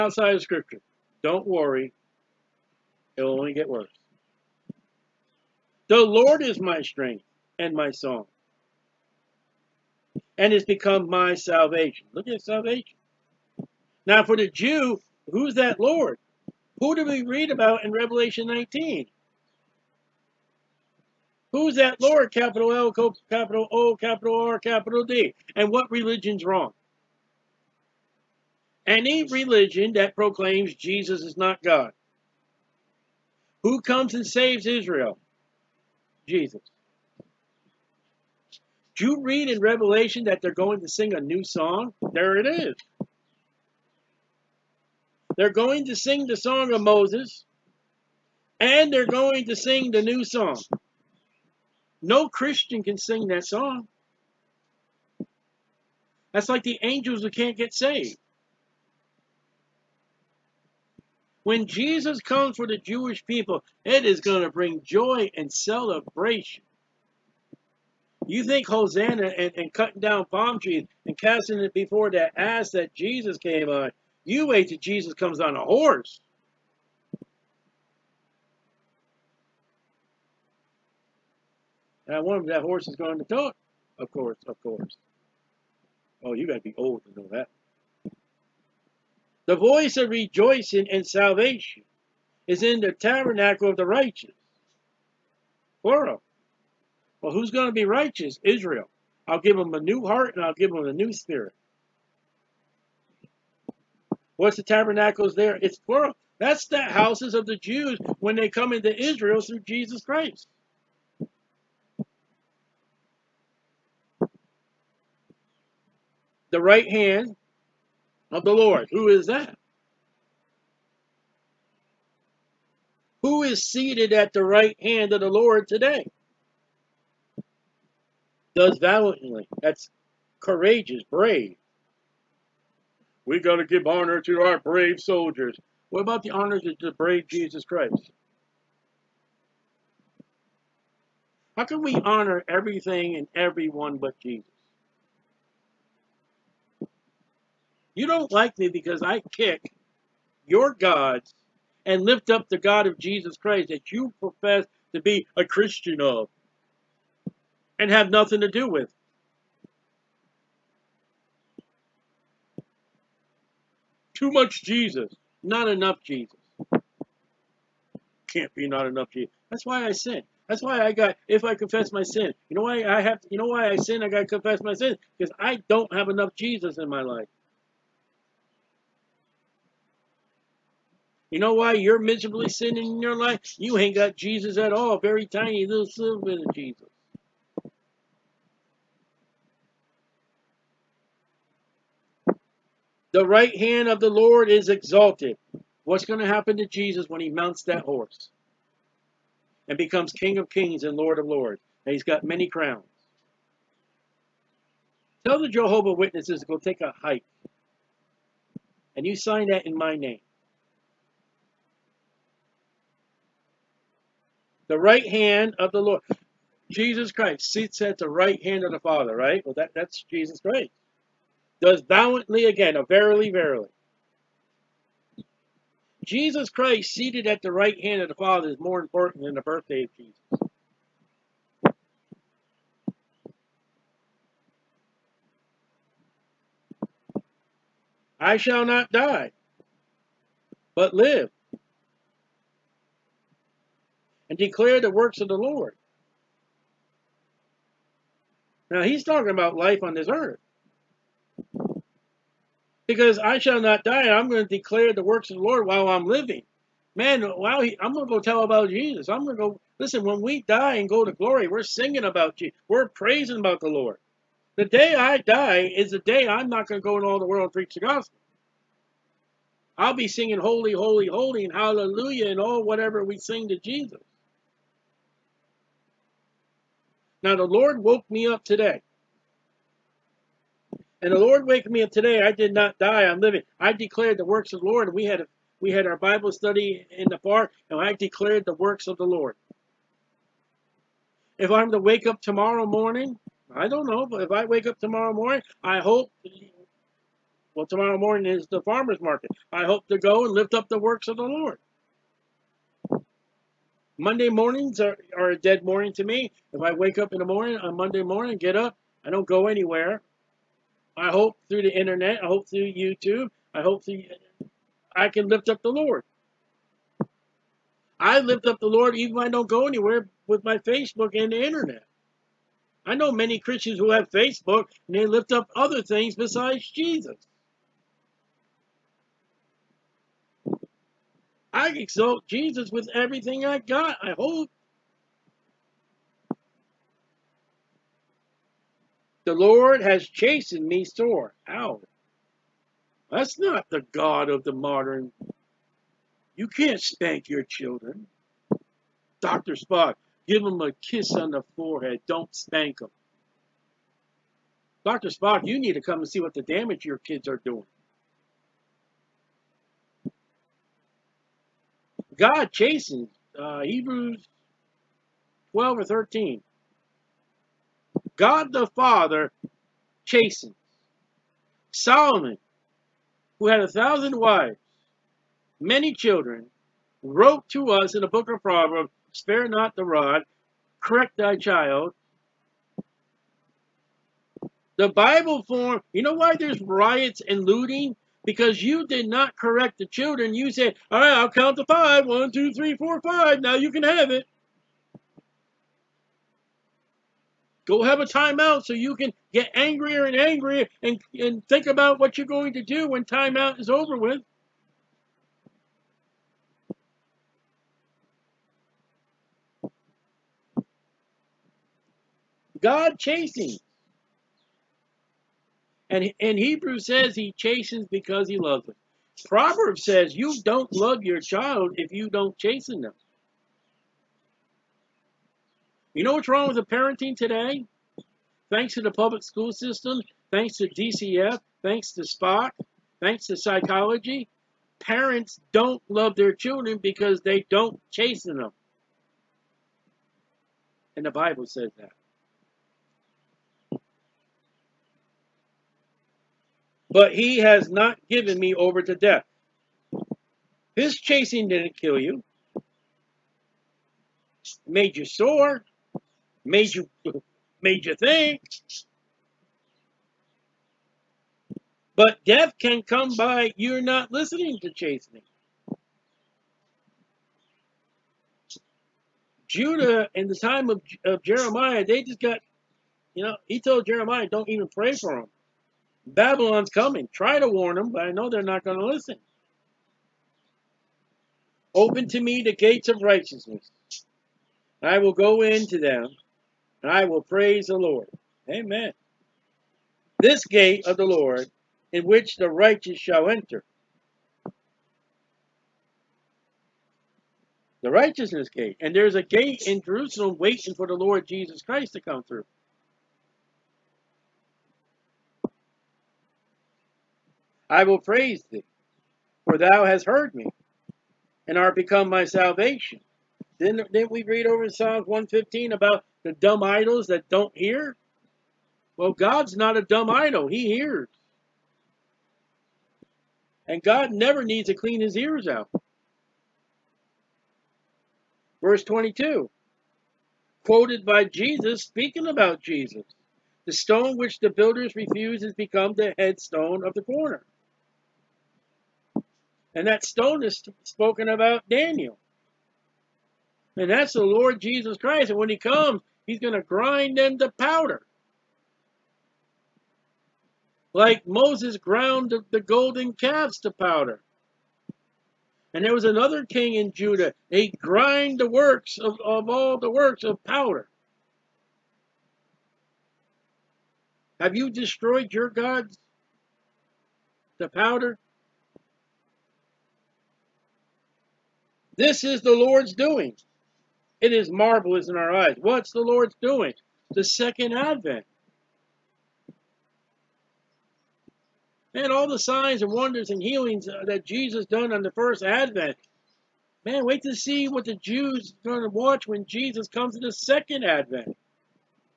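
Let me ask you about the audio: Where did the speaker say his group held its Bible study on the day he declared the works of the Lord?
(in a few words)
In the park.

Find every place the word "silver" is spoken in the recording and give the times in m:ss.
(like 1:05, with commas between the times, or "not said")
3:05.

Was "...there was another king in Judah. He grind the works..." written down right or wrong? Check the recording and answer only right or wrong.
right.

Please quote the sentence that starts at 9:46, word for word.
Man, wait to see what the Jews are going to watch when Jesus comes to the second advent.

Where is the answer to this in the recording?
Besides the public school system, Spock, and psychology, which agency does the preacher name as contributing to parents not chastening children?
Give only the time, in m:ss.
7:10.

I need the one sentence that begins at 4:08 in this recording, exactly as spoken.
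Now he's talking about life on this earth.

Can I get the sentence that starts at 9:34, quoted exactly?
It is marvelous in our eyes.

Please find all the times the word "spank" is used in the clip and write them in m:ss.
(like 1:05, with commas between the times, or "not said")
5:46, 5:52.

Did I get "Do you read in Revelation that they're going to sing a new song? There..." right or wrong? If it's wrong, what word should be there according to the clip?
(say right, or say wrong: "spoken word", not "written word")
right.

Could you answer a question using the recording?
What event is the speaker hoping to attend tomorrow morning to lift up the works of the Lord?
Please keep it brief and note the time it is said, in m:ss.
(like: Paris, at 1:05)
The farmer's market, at 4:58.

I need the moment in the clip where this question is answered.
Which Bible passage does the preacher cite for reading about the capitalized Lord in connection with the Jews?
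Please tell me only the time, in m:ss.
0:17.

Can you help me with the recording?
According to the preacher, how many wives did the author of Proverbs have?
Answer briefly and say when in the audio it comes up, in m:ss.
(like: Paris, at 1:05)
1000, at 6:13.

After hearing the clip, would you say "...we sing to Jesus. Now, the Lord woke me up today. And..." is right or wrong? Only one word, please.
right.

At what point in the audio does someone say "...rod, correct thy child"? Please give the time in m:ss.
6:19.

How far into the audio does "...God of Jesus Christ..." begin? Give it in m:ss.
2:32.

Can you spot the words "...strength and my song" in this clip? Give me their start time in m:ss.
0:06.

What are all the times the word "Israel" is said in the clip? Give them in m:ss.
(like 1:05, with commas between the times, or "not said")
0:34, 1:38, 1:48.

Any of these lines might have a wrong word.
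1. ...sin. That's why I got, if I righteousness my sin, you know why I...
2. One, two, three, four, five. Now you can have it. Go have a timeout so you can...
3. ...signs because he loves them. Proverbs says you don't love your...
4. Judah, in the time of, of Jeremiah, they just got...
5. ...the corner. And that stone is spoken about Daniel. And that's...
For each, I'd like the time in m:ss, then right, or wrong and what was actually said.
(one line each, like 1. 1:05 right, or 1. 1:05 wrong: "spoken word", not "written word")
1. 2:49 wrong: "confess", not "righteousness"
2. 6:32 right
3. 6:57 wrong: "chastens", not "signs"
4. 7:49 right
5. 8:56 right.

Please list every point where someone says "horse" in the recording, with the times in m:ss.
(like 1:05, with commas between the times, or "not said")
1:15, 1:22, 3:17.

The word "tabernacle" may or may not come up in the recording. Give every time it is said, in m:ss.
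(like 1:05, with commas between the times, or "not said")
1:32, 1:44.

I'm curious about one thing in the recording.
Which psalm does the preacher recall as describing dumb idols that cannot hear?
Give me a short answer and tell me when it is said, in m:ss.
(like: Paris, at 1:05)
Psalms 115, at 8:34.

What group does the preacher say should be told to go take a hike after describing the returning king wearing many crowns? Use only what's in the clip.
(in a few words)
Jehovah Witnesses.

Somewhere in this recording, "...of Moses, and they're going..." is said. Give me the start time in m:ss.
0:46.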